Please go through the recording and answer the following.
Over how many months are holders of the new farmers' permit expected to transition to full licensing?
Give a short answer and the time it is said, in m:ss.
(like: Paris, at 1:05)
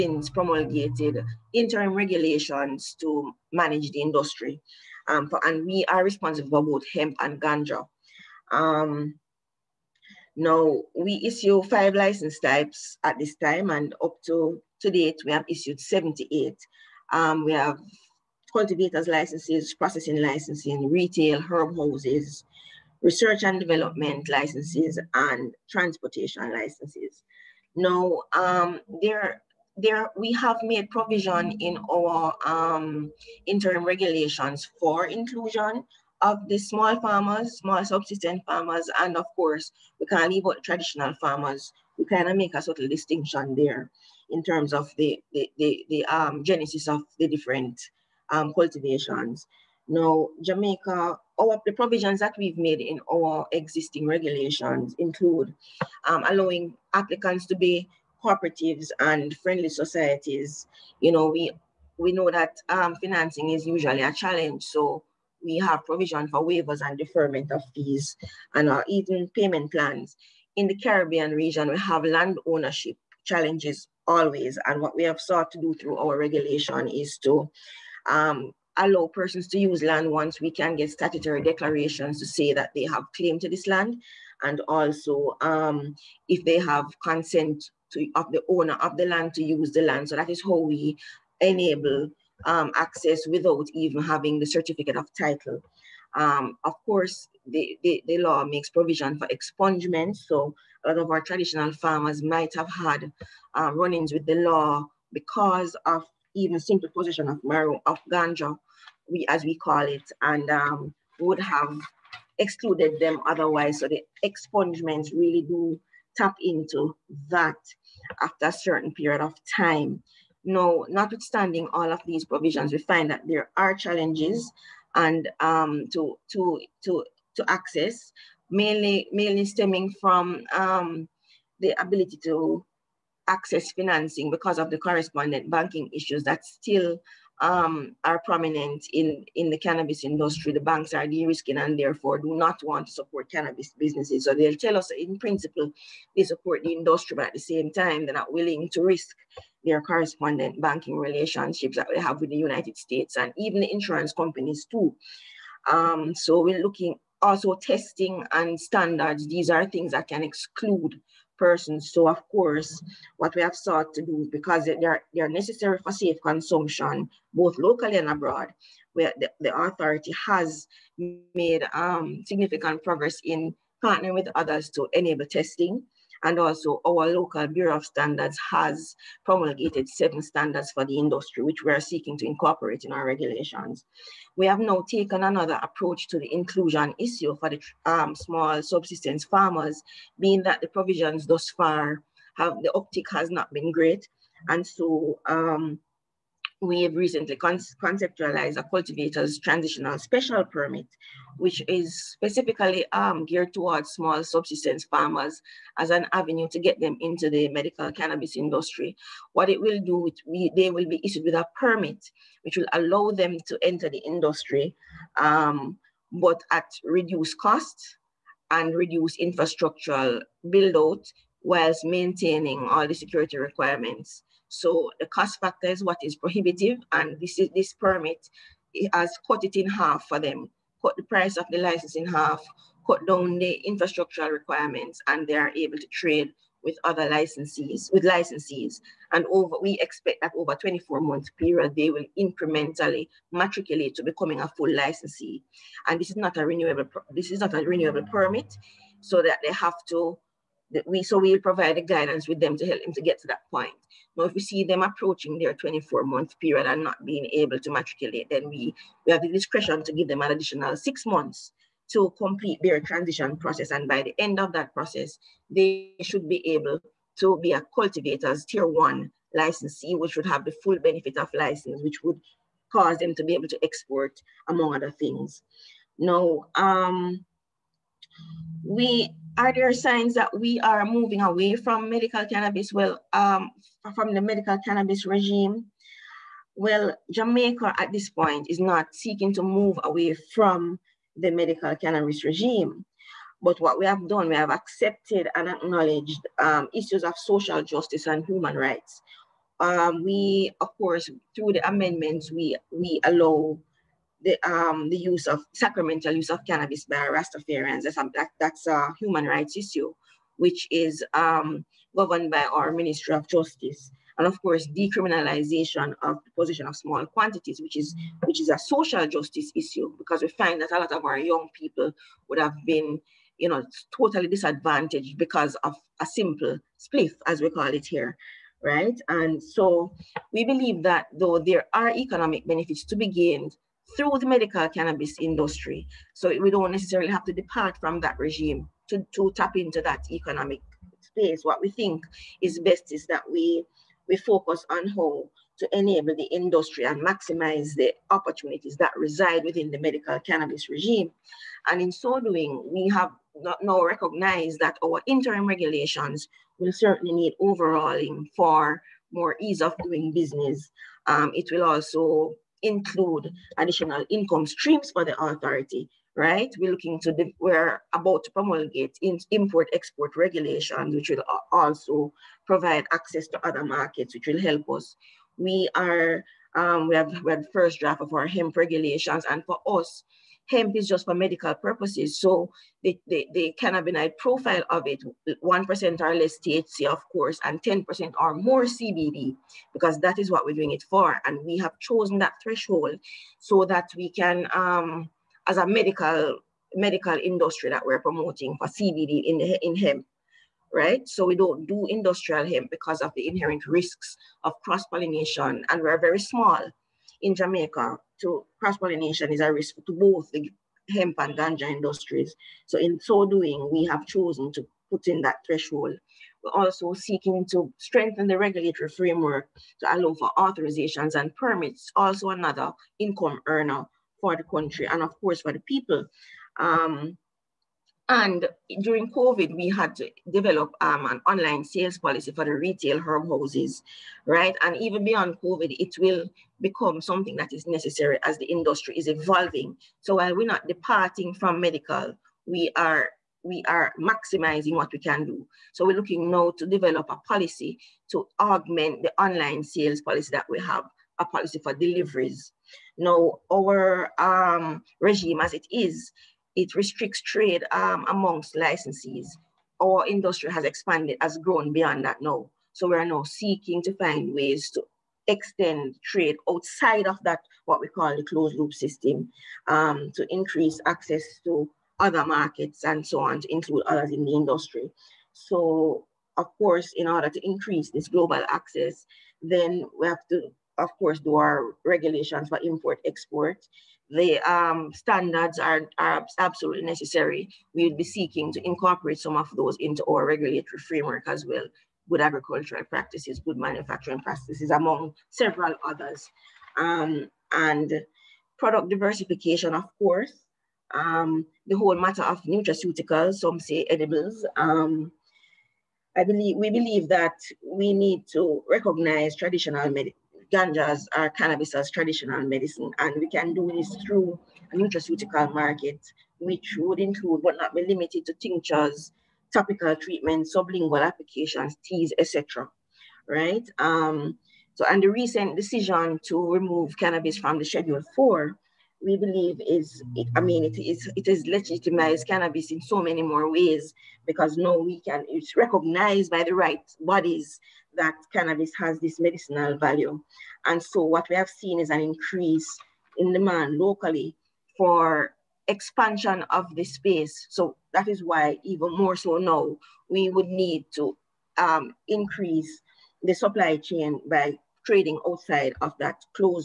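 24, at 4:00.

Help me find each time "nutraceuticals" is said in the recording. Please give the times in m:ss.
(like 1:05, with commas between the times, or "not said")
8:22, 8:34.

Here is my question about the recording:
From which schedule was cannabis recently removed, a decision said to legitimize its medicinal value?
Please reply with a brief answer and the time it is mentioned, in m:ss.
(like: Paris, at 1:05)
Schedule 4, at 8:47.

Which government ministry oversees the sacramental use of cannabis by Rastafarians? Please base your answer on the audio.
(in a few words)
Ministry of Justice.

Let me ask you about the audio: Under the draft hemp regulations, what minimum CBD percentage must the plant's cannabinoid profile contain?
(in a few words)
10%.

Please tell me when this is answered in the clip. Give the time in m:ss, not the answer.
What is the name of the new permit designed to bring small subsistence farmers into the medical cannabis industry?
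3:18.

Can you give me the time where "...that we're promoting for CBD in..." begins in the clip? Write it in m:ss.
6:37.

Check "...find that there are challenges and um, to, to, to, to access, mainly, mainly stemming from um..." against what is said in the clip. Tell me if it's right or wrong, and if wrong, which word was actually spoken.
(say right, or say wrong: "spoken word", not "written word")
right.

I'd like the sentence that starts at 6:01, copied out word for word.
Um, it will also include additional income streams for the authority, right?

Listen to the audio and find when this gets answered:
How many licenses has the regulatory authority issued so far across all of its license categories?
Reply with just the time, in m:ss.
0:15.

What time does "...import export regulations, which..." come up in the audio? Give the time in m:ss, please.
6:09.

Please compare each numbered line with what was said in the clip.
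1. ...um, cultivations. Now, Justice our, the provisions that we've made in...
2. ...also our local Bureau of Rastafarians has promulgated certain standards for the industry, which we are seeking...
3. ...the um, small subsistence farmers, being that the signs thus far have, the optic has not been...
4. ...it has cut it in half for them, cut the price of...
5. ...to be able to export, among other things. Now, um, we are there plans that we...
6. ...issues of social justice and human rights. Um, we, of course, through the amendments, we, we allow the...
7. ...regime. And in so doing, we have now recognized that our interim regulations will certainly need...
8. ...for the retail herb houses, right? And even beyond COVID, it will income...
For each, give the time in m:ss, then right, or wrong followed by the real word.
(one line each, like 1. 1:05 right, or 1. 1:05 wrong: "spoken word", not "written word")
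1. 0:48 wrong: "Jamaica", not "Justice"
2. 2:56 wrong: "Standards", not "Rastafarians"
3. 3:07 wrong: "provisions", not "signs"
4. 3:48 right
5. 4:33 wrong: "signs", not "plans"
6. 4:56 right
7. 5:50 right
8. 7:12 wrong: "become", not "income".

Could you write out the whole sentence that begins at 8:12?
Good agricultural practices, good manufacturing practices, among several others.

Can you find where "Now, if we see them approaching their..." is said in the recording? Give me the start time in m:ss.
4:14.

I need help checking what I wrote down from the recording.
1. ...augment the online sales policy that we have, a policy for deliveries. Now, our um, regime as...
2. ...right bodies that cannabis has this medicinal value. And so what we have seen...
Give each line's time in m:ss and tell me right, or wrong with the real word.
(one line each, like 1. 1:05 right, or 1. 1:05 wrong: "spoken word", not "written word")
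1. 7:28 right
2. 8:56 right.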